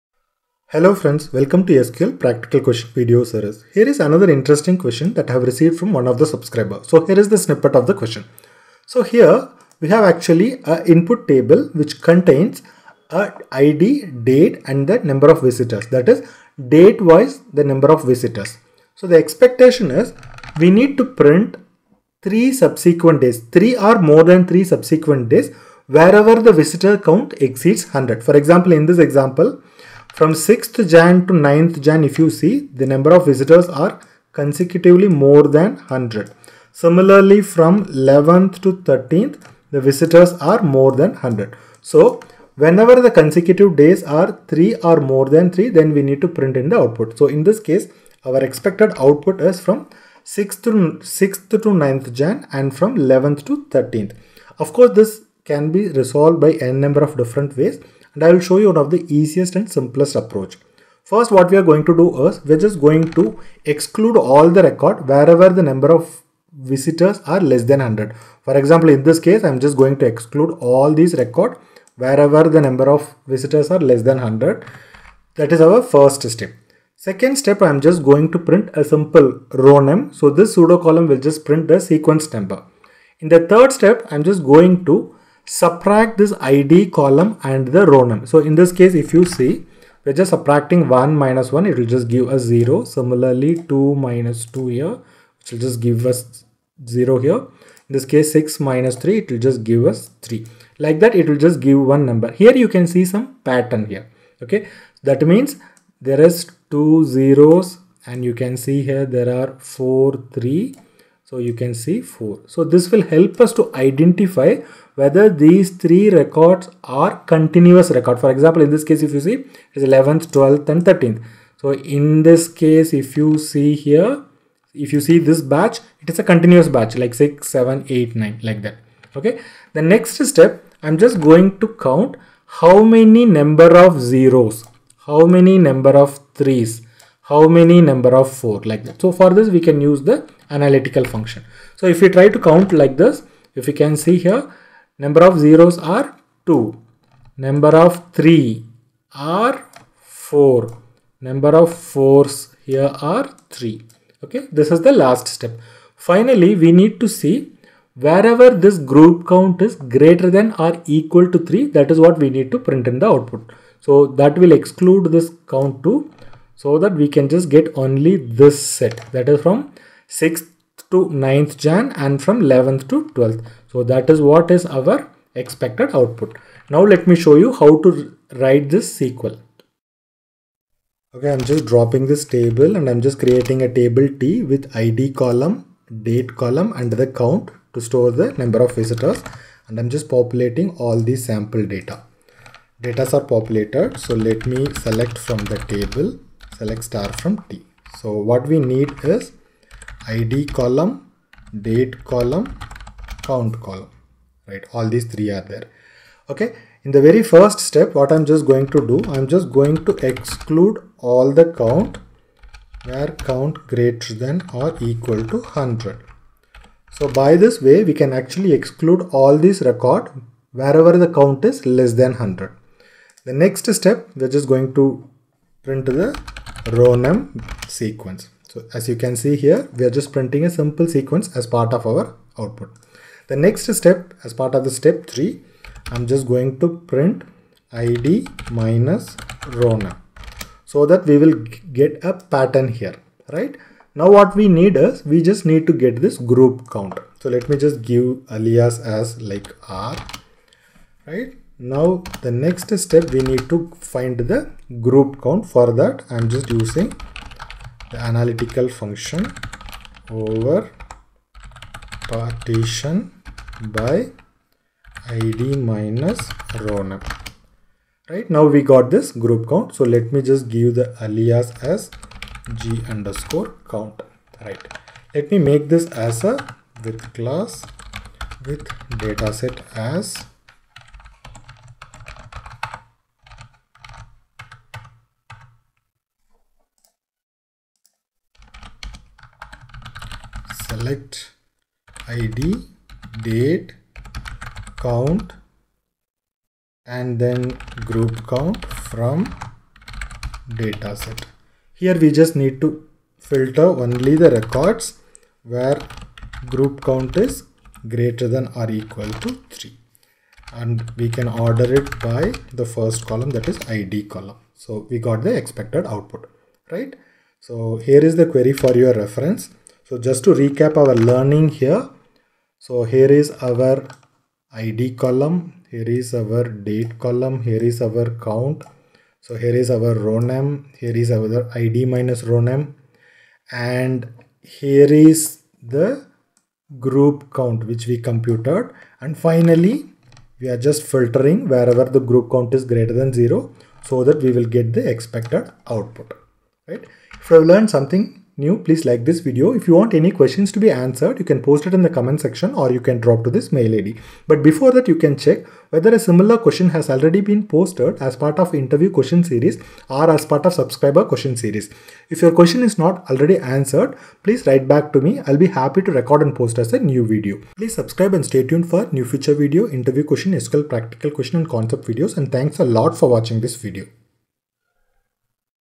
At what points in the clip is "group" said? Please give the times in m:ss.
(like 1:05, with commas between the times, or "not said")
2:38, 4:06, 4:14, 4:29, 4:57, 5:06, 5:36, 5:41.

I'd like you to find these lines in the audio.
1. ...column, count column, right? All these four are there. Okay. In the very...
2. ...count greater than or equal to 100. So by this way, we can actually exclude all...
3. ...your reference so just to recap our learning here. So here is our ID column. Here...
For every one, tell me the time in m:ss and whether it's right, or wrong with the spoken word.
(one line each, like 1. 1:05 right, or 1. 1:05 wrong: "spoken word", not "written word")
1. 3:22 wrong: "three", not "four"
2. 3:33 right
3. 5:18 right.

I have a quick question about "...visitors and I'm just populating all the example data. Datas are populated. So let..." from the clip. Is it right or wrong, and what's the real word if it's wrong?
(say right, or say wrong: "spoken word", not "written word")
wrong: "sample", not "example".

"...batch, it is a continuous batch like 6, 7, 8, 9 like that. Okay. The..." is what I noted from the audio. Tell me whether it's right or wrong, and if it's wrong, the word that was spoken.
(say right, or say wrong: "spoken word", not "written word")
right.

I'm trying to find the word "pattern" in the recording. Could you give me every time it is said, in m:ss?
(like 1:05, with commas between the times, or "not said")
1:43, 4:02.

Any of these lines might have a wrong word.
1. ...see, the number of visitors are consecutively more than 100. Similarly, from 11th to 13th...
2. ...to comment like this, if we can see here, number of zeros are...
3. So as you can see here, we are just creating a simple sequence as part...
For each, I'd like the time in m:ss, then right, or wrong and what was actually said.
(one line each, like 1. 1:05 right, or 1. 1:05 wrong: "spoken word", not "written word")
1. 0:32 right
2. 2:22 wrong: "count", not "comment"
3. 3:48 wrong: "printing", not "creating".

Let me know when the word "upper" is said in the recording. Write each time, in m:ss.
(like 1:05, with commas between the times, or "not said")
not said.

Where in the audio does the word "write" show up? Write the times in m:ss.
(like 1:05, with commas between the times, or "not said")
2:58, 6:04.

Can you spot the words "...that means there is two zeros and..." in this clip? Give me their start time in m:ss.
1:45.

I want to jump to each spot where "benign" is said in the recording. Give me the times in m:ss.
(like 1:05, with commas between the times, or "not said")
not said.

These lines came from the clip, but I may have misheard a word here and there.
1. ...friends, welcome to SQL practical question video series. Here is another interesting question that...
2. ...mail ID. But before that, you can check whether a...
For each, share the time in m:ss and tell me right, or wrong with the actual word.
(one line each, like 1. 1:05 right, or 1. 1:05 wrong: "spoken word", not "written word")
1. 0:00 right
2. 5:53 right.